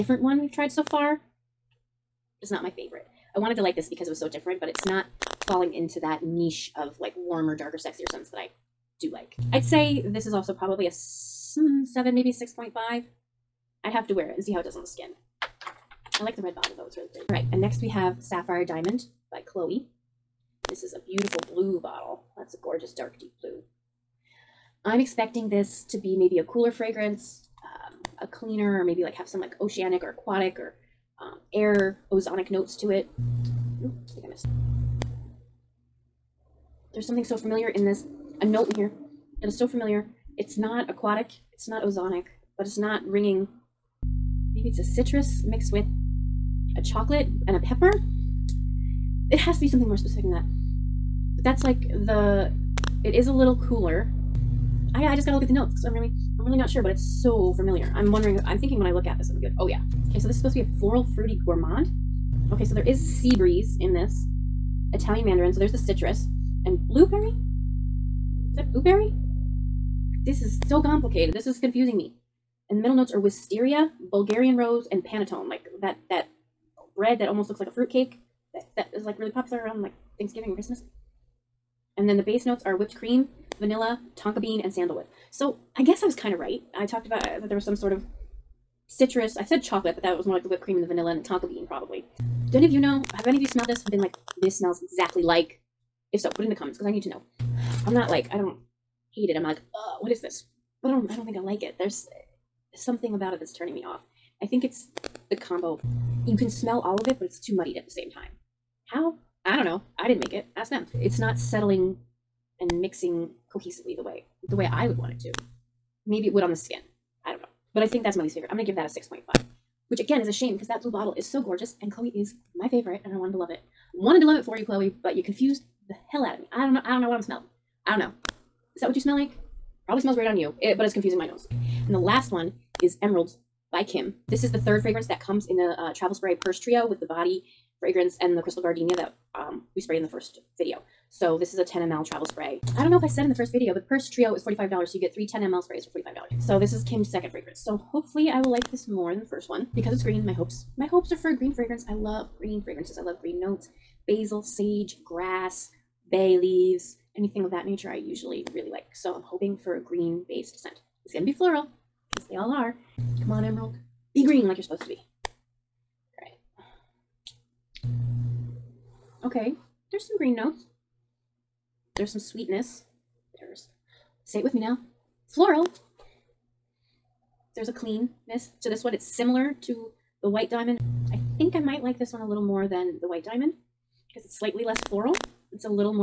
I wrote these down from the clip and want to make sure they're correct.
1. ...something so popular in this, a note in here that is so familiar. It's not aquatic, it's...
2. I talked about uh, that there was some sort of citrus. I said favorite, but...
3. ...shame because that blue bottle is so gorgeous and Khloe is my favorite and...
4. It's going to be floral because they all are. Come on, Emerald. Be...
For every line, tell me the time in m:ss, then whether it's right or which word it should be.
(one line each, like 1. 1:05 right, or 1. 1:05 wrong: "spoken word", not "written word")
1. 0:37 wrong: "familiar", not "popular"
2. 1:26 wrong: "chocolate", not "favorite"
3. 2:00 right
4. 2:41 right.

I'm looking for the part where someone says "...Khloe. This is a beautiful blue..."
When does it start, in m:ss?
0:19.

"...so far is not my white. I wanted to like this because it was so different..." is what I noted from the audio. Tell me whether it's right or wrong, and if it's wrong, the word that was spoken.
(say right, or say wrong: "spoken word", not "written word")
wrong: "favorite", not "white".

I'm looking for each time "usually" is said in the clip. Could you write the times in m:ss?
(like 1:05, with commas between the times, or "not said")
2:37.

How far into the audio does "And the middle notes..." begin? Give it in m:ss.
1:12.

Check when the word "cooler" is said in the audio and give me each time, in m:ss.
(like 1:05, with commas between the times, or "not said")
0:26, 0:53.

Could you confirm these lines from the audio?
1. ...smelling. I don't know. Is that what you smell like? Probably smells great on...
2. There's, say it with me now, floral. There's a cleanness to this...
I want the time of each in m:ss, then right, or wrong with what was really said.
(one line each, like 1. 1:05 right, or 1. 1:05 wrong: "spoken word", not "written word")
1. 2:07 right
2. 2:53 right.